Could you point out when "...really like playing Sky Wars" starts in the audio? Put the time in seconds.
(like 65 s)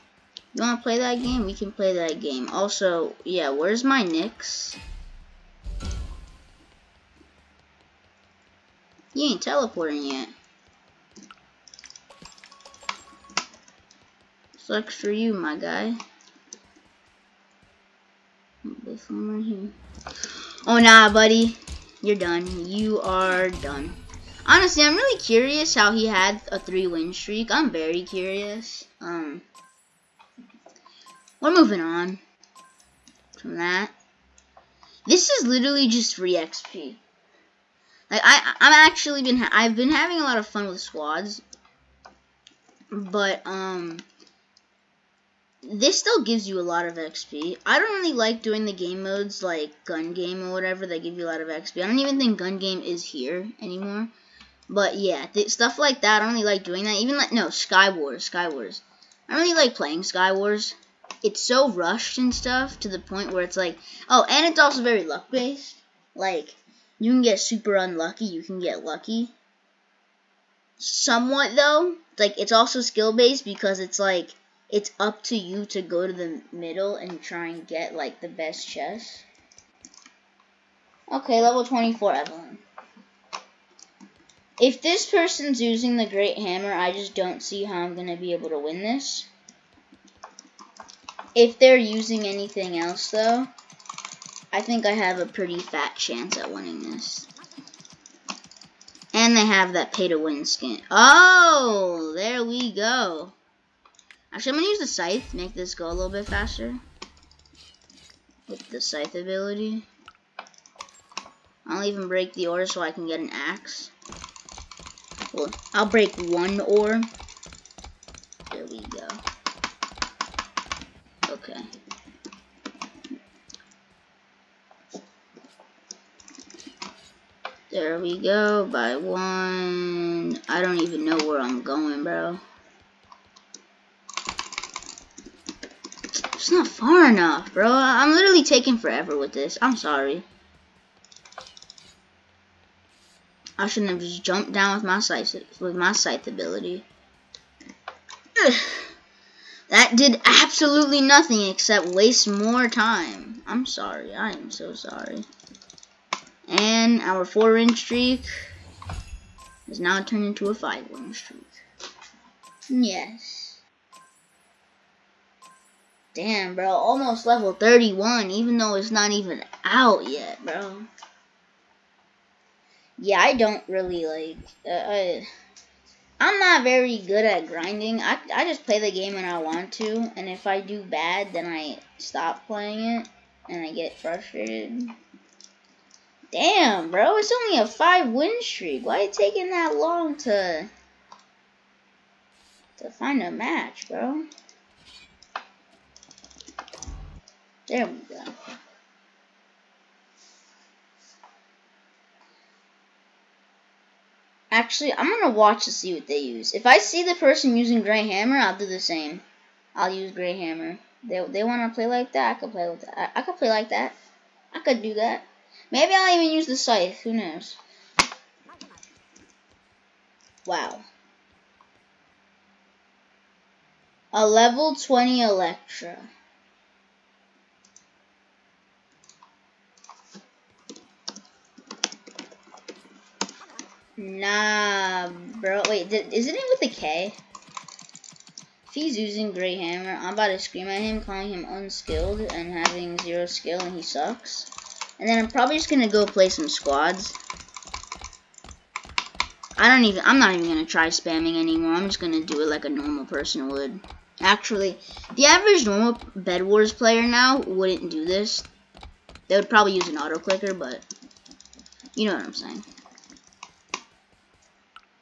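59 s.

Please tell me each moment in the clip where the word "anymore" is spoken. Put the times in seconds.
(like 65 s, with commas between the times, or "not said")
53 s, 251 s.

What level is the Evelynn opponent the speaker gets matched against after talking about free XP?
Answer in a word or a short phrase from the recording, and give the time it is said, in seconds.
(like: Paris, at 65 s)
24, at 81 s.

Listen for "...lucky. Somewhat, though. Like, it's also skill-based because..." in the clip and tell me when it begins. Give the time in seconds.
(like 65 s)
68 s.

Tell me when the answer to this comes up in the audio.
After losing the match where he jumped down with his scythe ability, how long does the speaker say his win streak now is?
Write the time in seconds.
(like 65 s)
187 s.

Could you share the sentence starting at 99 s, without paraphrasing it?
And they have that pay-to-win skin.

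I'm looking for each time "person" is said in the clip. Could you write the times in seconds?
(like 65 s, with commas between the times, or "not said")
85 s, 207 s, 253 s.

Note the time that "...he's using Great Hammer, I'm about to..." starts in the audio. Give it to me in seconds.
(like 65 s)
238 s.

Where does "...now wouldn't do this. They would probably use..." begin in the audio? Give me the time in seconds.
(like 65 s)
257 s.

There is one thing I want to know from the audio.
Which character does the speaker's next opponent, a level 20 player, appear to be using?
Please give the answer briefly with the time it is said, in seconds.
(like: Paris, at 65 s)
Electra, at 225 s.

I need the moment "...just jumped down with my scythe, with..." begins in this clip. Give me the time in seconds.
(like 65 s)
143 s.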